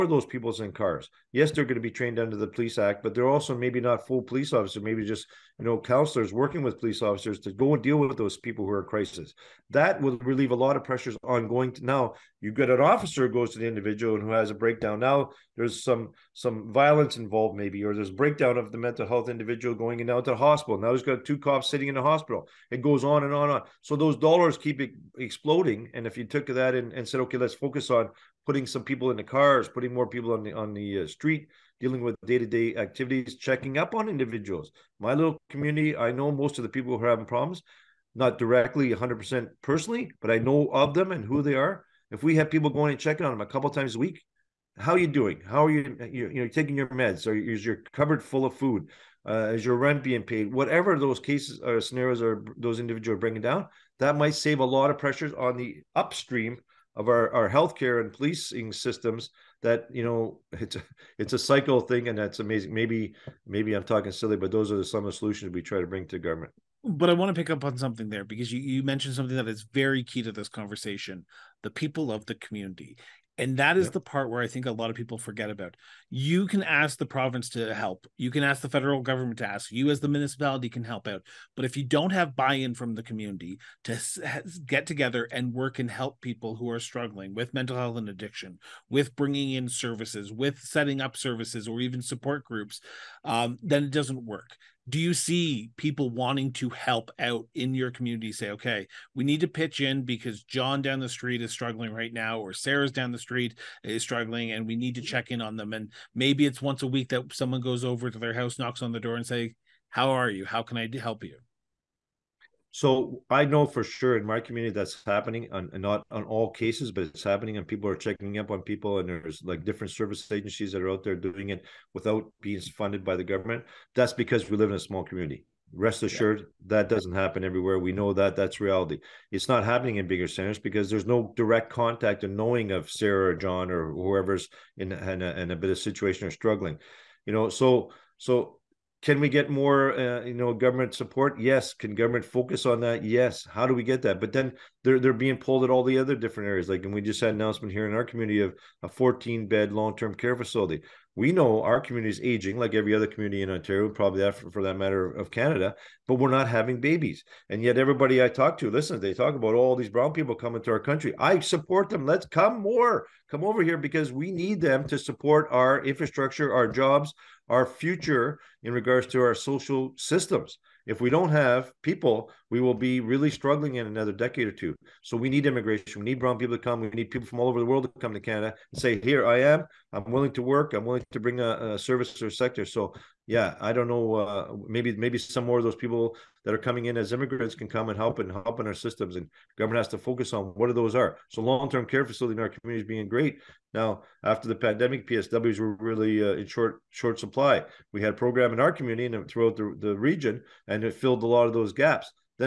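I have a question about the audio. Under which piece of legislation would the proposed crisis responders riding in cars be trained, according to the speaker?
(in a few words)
Police Act.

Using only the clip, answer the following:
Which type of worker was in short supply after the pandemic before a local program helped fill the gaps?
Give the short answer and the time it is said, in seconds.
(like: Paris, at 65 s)
PSWs, at 195 s.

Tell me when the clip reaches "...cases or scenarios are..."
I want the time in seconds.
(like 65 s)
51 s.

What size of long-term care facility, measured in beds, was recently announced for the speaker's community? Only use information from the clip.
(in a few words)
14 beds.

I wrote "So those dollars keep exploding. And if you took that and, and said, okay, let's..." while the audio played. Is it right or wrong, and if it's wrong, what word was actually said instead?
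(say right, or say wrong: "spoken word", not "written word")
right.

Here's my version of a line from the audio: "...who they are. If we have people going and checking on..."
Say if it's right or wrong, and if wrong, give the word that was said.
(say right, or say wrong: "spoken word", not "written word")
right.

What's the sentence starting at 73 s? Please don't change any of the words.
the part where I think a lot of people forget about.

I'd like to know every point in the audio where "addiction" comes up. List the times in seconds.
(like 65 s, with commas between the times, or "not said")
88 s.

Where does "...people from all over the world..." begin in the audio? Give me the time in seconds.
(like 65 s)
177 s.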